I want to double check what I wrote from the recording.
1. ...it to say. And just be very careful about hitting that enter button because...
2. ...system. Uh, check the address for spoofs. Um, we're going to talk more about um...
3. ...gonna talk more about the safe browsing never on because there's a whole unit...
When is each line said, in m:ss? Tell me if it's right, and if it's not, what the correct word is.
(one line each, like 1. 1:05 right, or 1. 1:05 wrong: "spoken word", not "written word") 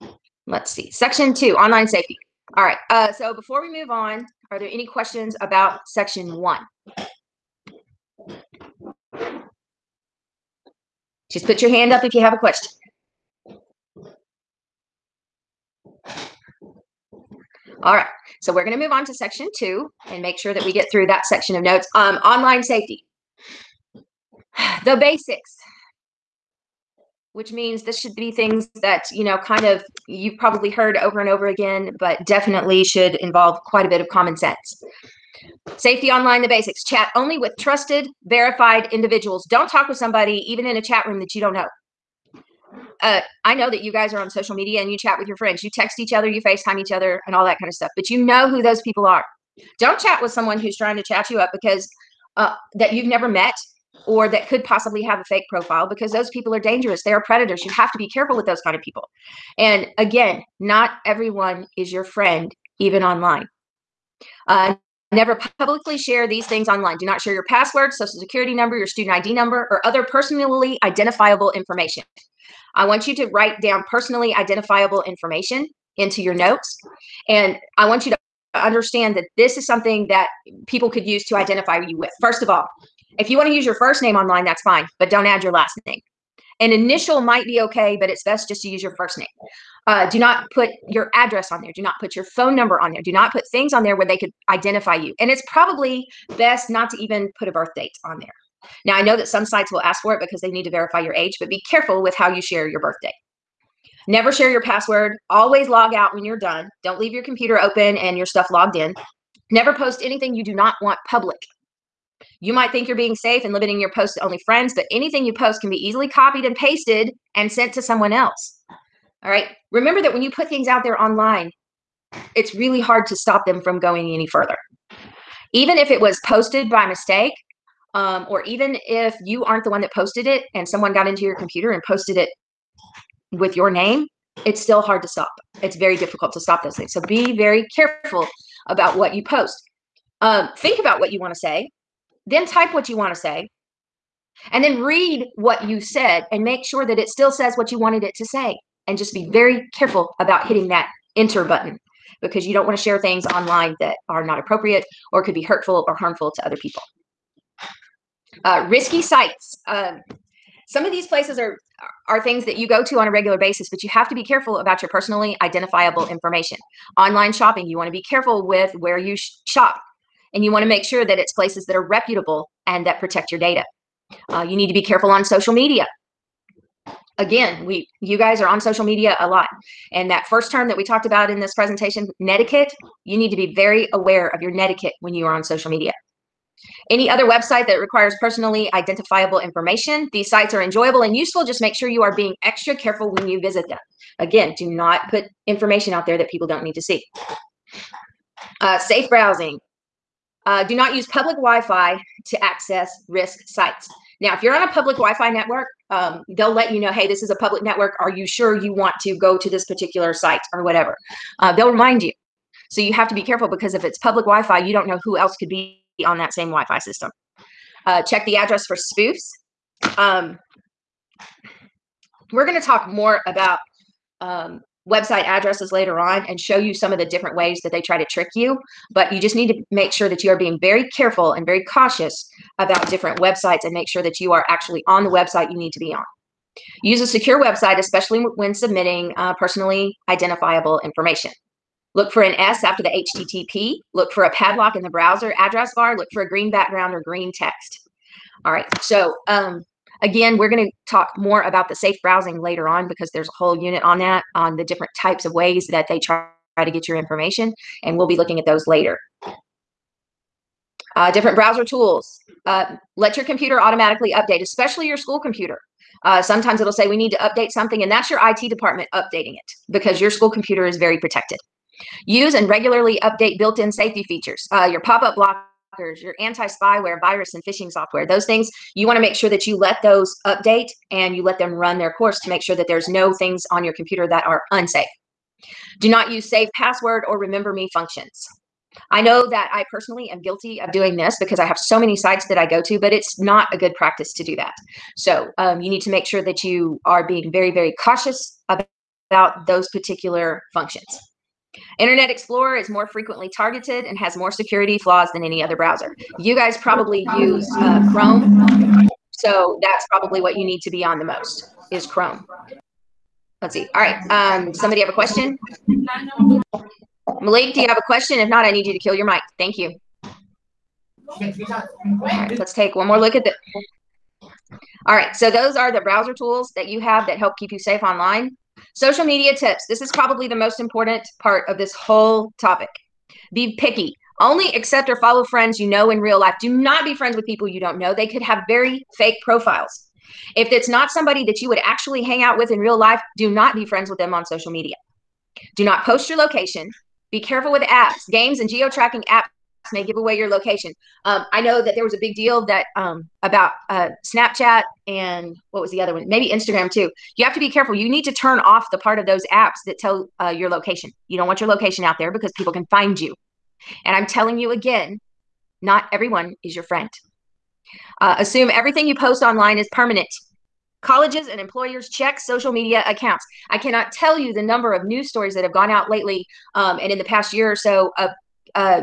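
1. 2:28 right
2. 3:36 right
3. 4:10 wrong: "later", not "never".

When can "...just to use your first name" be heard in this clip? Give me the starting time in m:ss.
1:28.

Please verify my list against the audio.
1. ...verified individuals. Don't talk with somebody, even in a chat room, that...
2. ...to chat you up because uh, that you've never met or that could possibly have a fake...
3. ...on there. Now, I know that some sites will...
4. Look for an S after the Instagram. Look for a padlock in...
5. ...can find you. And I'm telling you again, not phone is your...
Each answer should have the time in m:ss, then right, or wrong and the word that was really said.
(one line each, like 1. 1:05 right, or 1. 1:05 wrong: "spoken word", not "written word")
1. 0:38 right
2. 0:50 right
3. 1:38 right
4. 4:01 wrong: "HTTP", not "Instagram"
5. 6:02 wrong: "everyone", not "phone".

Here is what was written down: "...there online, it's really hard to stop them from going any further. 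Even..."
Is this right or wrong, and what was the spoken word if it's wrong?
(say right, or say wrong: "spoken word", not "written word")
right.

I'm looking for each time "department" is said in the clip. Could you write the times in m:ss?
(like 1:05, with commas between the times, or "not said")
4:28.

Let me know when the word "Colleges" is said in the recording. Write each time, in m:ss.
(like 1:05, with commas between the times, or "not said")
6:10.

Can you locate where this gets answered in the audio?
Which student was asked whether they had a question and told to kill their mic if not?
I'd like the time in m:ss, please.
5:17.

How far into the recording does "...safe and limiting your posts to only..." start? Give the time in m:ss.
1:53.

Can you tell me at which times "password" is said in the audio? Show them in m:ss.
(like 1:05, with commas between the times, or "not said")
1:07, 1:44, 4:46.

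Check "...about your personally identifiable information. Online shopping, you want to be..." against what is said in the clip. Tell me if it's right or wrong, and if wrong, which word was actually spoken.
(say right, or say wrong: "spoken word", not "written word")
right.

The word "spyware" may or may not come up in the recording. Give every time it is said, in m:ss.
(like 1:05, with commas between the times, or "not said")
4:36.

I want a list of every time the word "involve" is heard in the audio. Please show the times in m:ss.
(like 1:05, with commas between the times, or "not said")
0:33.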